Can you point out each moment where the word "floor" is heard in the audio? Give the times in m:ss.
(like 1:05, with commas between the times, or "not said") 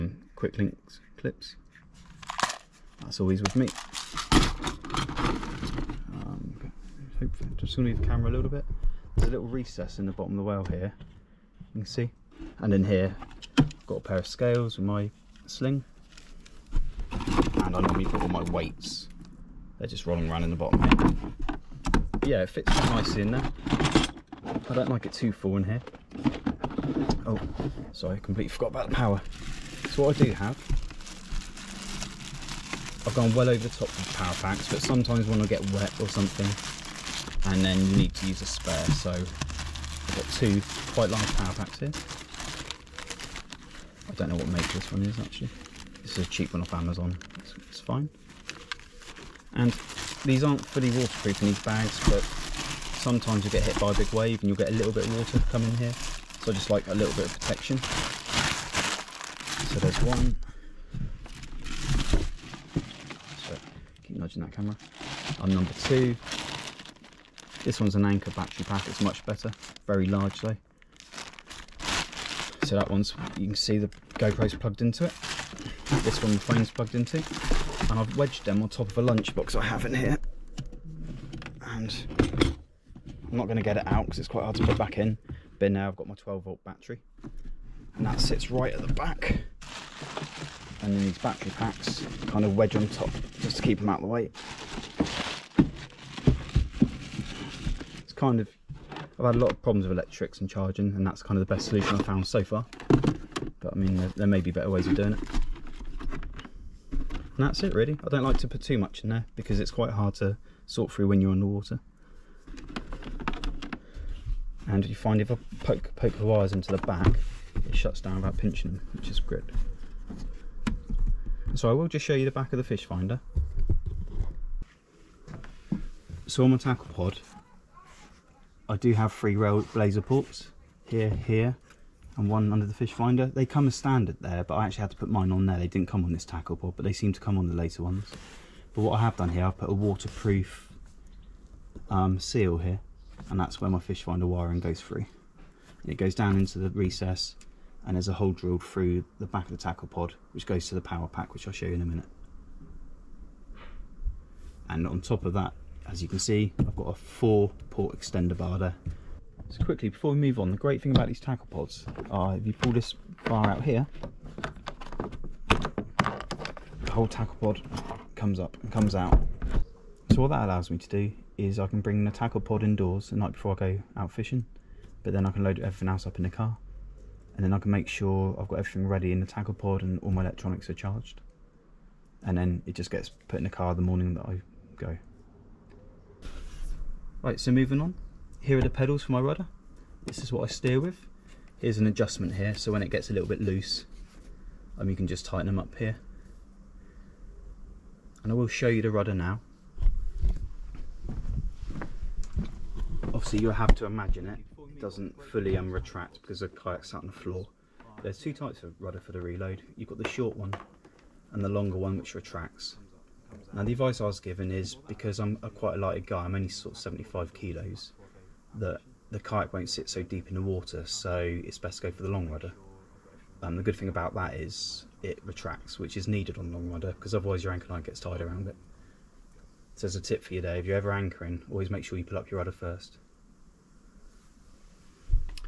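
3:27.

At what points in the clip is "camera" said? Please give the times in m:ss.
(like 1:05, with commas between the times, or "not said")
0:08, 1:04.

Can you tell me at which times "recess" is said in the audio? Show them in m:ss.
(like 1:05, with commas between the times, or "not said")
0:09, 2:26.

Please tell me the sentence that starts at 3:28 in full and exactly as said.
There's two types of rudder for the reload.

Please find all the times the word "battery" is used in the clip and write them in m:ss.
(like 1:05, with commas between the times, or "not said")
1:08, 1:26, 1:31.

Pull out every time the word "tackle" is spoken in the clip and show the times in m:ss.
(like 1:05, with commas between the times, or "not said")
2:06, 2:16, 2:29, 2:41, 2:47, 2:52, 2:59.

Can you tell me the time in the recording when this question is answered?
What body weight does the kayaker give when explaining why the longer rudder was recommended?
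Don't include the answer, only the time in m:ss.
3:36.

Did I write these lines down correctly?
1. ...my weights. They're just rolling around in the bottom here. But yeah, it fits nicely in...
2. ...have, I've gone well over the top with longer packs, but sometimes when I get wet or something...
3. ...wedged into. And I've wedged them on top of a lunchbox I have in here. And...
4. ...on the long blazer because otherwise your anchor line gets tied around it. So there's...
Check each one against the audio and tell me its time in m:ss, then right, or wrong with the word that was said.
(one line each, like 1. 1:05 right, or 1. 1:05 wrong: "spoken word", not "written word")
1. 0:18 right
2. 0:30 wrong: "power", not "longer"
3. 1:16 wrong: "plugged", not "wedged"
4. 3:46 wrong: "rudder", not "blazer".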